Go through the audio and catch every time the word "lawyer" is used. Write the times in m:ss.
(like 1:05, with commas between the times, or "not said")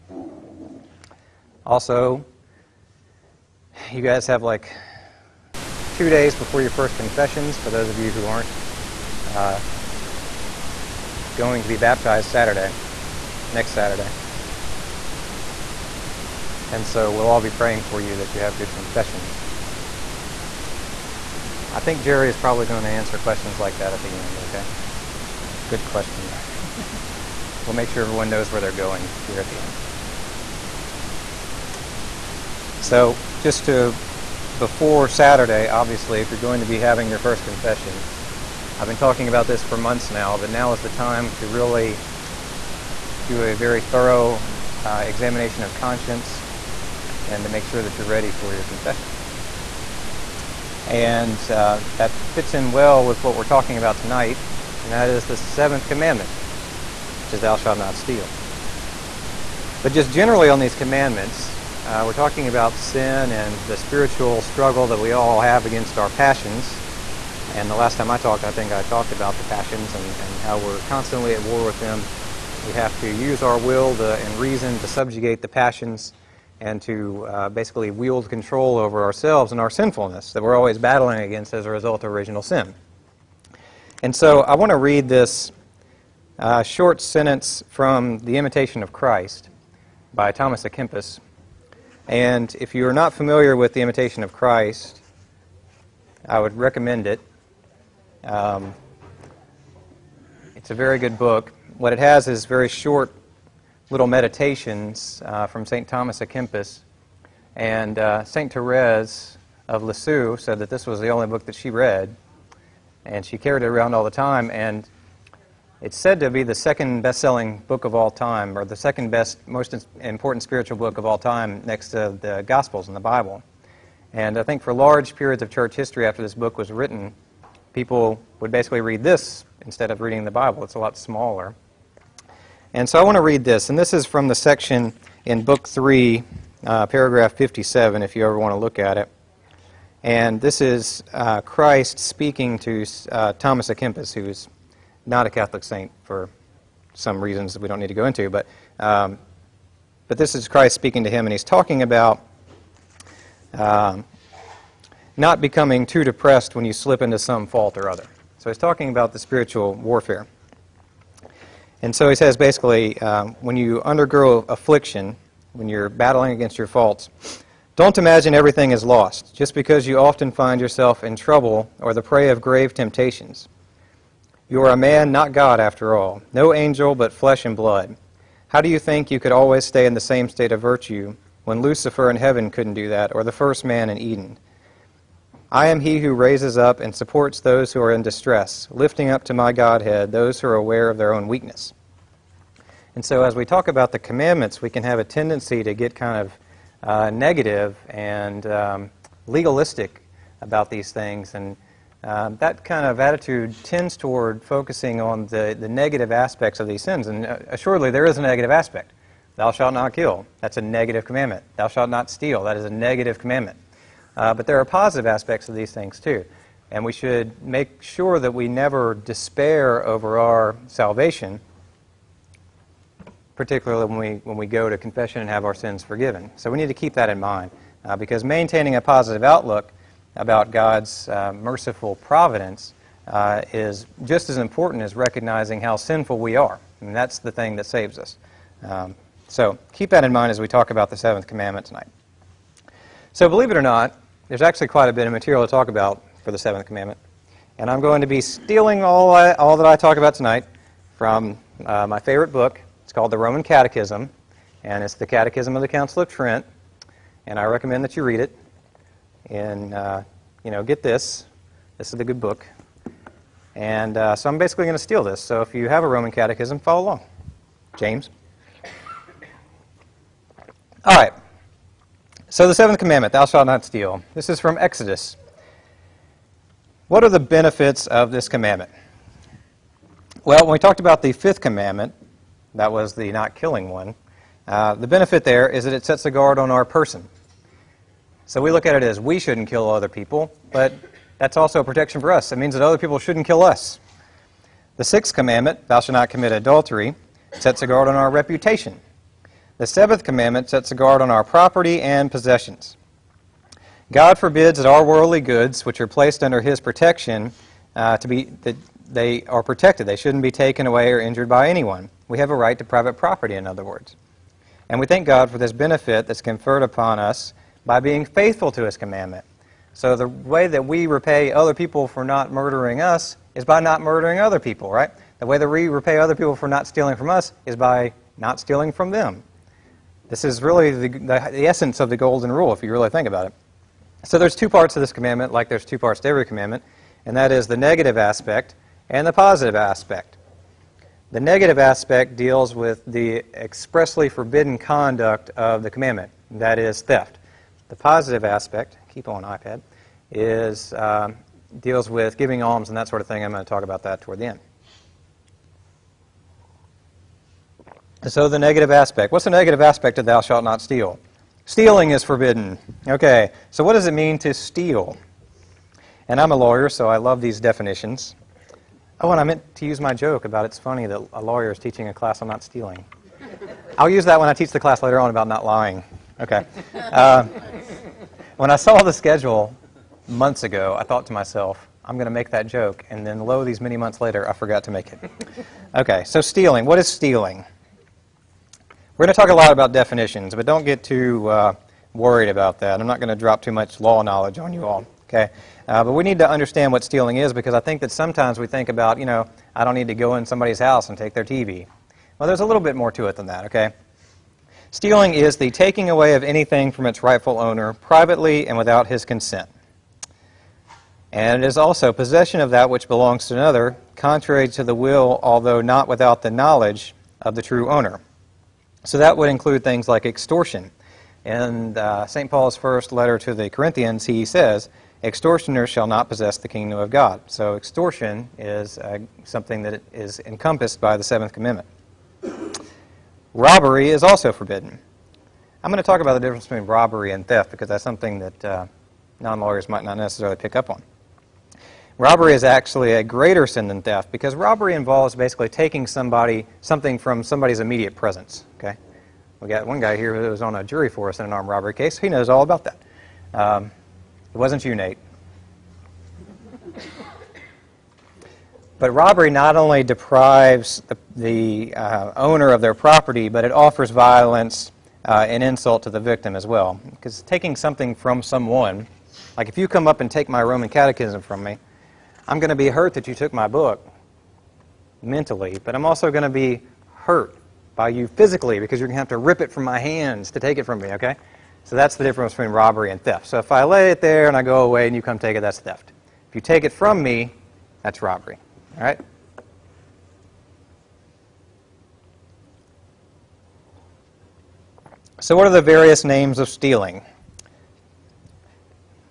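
6:06, 6:11, 7:19.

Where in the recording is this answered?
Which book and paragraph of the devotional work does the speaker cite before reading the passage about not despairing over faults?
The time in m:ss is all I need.
2:15.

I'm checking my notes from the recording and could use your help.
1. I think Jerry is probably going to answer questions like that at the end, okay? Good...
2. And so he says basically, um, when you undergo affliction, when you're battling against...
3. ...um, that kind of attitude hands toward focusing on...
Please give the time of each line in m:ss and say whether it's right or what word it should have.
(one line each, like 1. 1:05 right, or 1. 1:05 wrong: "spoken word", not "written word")
1. 0:21 right
2. 2:41 right
3. 3:22 wrong: "tends", not "hands".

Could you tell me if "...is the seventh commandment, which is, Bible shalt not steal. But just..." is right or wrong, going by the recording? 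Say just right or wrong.
wrong.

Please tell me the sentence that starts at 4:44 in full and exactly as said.
Uh, the benefit there is that it sets a guard on our person.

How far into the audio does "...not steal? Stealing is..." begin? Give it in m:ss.
6:00.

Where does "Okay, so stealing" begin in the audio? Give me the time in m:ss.
6:25.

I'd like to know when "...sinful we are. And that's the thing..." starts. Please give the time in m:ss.
3:55.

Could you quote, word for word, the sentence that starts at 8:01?
So that's the difference between robbery and theft.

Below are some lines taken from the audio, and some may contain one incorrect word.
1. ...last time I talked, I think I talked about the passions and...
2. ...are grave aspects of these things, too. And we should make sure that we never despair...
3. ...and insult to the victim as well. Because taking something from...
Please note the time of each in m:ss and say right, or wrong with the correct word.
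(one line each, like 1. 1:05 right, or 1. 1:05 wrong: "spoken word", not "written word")
1. 1:07 right
2. 3:34 wrong: "positive", not "grave"
3. 7:45 right.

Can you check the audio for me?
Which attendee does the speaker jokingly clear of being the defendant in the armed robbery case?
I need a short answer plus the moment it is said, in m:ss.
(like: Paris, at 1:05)
Nate, at 7:34.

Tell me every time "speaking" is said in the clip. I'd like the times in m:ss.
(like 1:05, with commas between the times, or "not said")
2:21, 2:30.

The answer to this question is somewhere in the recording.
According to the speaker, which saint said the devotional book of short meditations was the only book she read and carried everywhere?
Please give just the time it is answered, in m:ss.
1:48.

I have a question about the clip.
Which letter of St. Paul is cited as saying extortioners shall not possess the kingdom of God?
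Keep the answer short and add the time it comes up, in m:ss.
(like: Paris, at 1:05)
First letter to the Corinthians, at 7:02.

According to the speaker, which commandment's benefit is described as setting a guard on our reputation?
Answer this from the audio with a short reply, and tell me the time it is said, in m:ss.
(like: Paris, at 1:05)
The sixth commandment, at 4:54.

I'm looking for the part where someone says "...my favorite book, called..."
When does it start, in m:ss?
4:11.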